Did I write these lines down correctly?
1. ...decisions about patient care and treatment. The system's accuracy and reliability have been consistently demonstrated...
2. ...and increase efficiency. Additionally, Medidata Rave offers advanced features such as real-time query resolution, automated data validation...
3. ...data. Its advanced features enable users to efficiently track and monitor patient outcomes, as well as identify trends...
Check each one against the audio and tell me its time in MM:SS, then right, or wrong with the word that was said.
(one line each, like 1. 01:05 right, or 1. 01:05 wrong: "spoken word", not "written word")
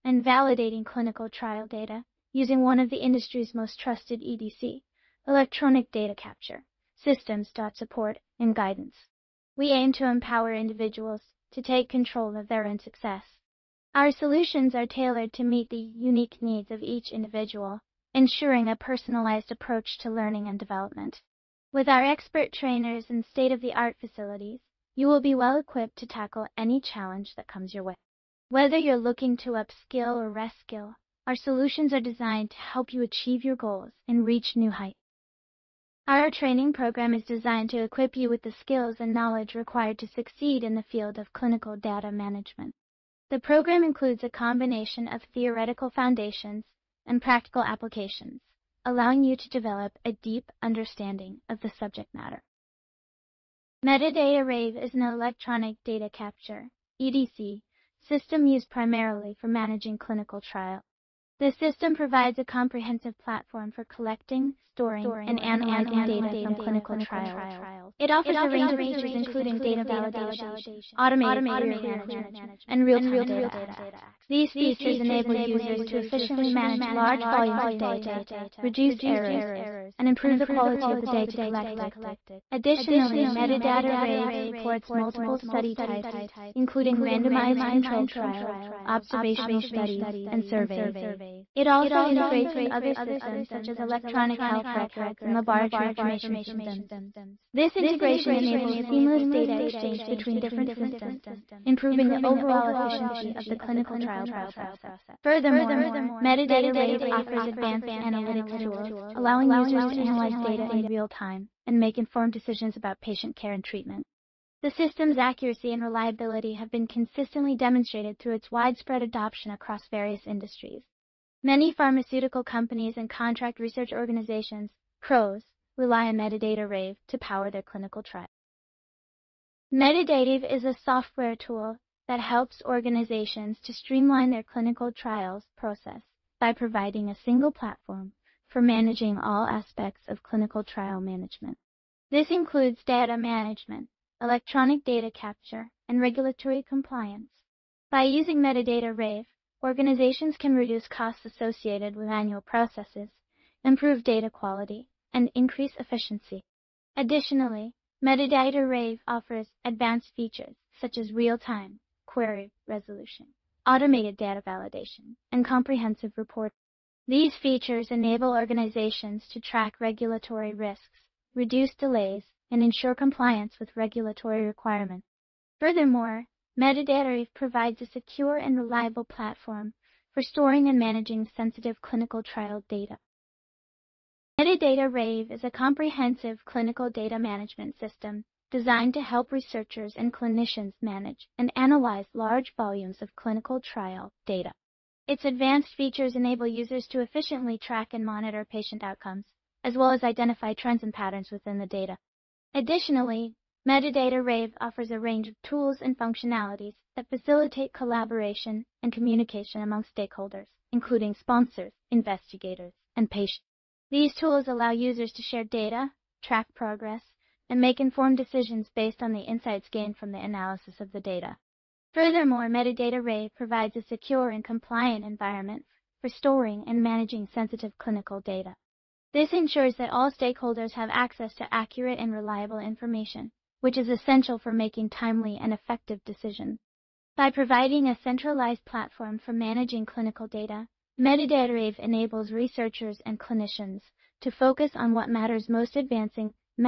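1. 01:52 right
2. 02:35 right
3. 03:14 right.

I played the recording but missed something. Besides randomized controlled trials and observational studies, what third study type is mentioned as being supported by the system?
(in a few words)
Surveys.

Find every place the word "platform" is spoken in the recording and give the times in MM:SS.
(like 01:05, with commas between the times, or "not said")
01:03, 02:17, 02:59, 03:58.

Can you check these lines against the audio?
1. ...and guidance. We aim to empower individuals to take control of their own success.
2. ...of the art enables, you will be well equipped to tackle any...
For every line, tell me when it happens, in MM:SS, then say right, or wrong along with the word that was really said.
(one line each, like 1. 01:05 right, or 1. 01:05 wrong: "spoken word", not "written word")
1. 00:08 right
2. 00:23 wrong: "facilities", not "enables".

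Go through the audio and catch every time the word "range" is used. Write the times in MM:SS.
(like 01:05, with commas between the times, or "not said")
01:08, 03:24.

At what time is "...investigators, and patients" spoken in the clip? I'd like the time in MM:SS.
03:31.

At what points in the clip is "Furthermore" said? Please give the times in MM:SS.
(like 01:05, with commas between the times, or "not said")
01:45, 02:55, 03:41.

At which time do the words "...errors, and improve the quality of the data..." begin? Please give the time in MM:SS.
01:19.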